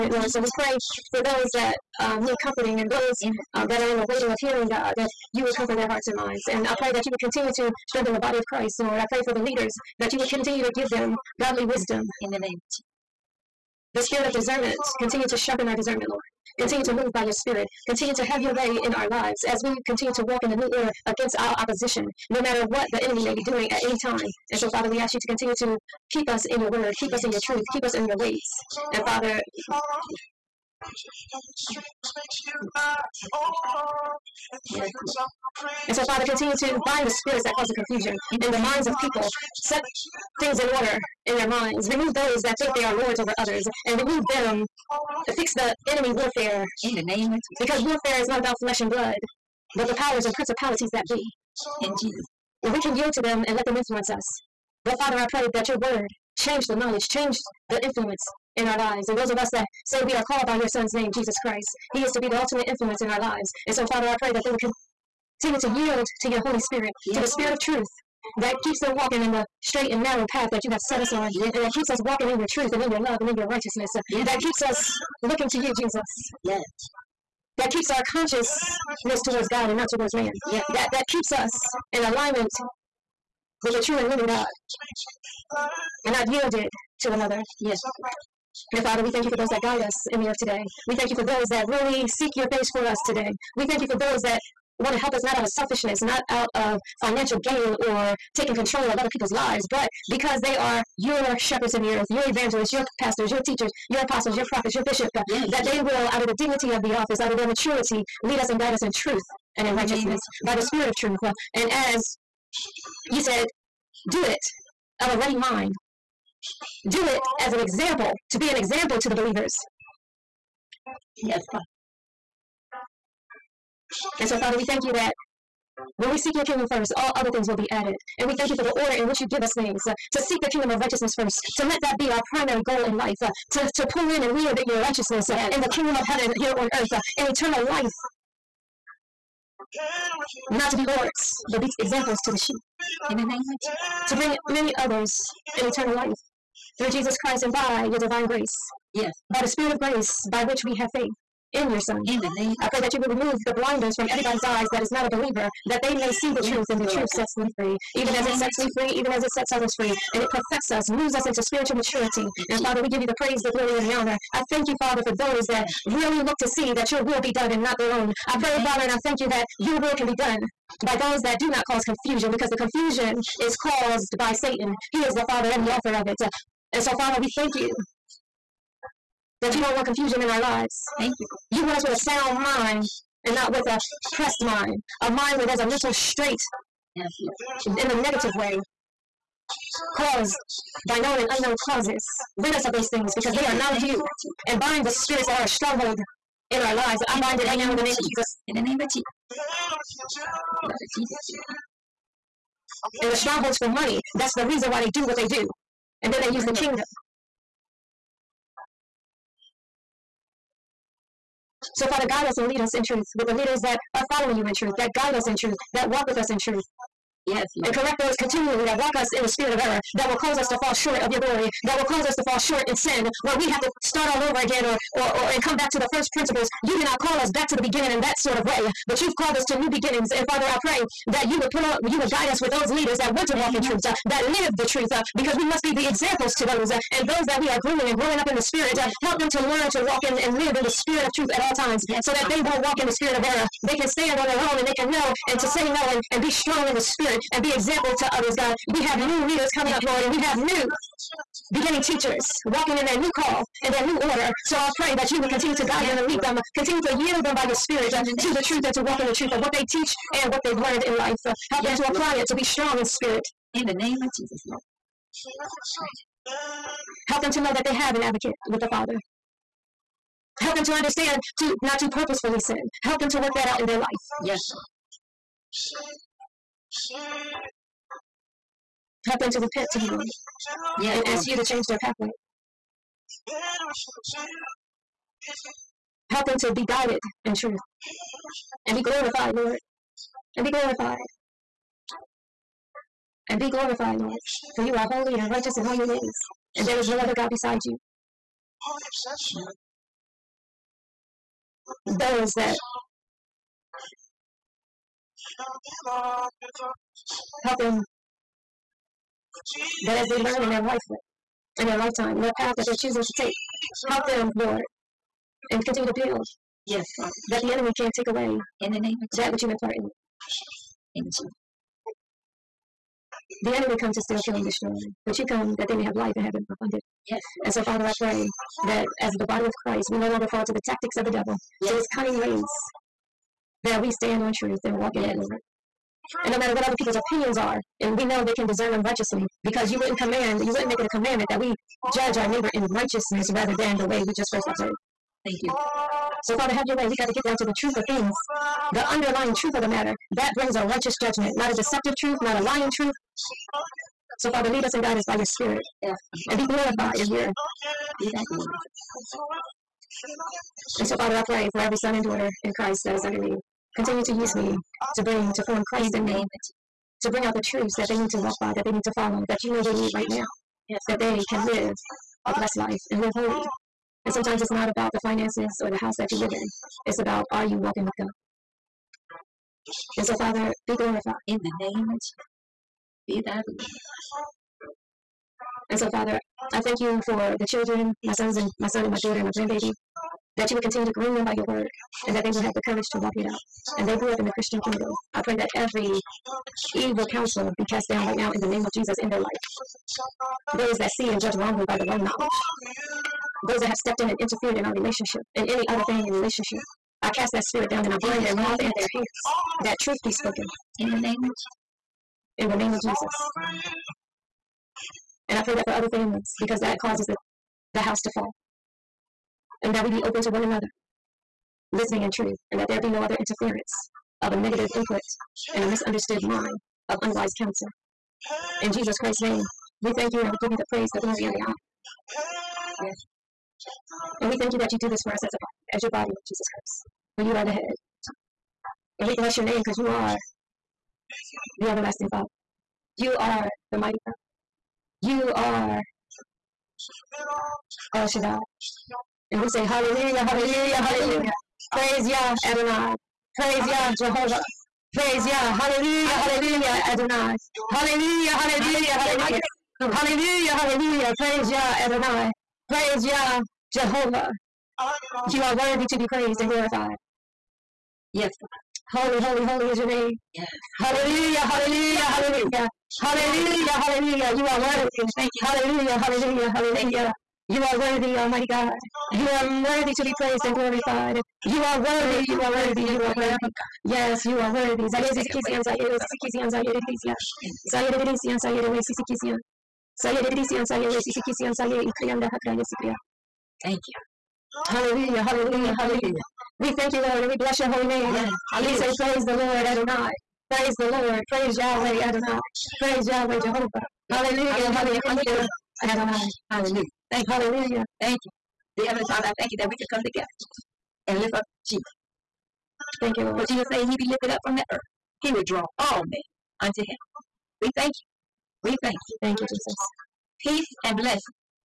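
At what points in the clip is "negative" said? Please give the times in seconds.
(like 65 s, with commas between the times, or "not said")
188 s, 424 s.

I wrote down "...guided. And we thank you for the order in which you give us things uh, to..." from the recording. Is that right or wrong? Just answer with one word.
wrong.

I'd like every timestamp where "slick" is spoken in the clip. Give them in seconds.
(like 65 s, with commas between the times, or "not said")
not said.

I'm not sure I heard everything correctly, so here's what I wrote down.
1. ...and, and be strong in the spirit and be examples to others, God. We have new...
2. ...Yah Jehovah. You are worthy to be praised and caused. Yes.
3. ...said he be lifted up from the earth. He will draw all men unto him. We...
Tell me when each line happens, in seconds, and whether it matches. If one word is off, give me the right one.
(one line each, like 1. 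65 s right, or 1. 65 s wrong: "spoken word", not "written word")
1. 245 s right
2. 463 s wrong: "glorified", not "caused"
3. 513 s right.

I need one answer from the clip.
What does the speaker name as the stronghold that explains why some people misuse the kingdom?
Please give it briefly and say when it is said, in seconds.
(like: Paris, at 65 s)
money, at 203 s.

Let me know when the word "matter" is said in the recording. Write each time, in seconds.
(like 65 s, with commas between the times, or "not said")
22 s, 336 s, 349 s.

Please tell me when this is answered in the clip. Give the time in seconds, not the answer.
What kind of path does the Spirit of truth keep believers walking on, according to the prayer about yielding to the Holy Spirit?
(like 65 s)
69 s.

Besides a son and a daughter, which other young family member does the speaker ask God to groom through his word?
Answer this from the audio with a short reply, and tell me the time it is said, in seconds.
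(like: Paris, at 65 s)
grandbaby, at 389 s.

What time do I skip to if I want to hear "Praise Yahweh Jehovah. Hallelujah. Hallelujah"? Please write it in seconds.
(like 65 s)
502 s.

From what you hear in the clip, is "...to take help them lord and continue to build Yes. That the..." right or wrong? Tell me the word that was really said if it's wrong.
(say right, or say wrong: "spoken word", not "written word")
right.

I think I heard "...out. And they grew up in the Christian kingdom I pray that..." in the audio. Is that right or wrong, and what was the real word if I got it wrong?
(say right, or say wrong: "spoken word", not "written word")
right.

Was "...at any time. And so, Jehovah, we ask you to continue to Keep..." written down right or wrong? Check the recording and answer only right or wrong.
wrong.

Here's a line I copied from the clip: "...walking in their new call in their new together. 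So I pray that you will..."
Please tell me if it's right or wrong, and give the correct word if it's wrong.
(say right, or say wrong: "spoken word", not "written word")
wrong: "order", not "together".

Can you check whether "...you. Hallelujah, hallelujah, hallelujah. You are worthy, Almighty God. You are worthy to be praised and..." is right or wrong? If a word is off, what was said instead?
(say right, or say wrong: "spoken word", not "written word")
right.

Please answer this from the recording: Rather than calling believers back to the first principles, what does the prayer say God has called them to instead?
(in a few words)
new beginnings.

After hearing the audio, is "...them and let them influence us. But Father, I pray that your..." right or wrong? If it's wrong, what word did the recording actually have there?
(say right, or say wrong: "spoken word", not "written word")
right.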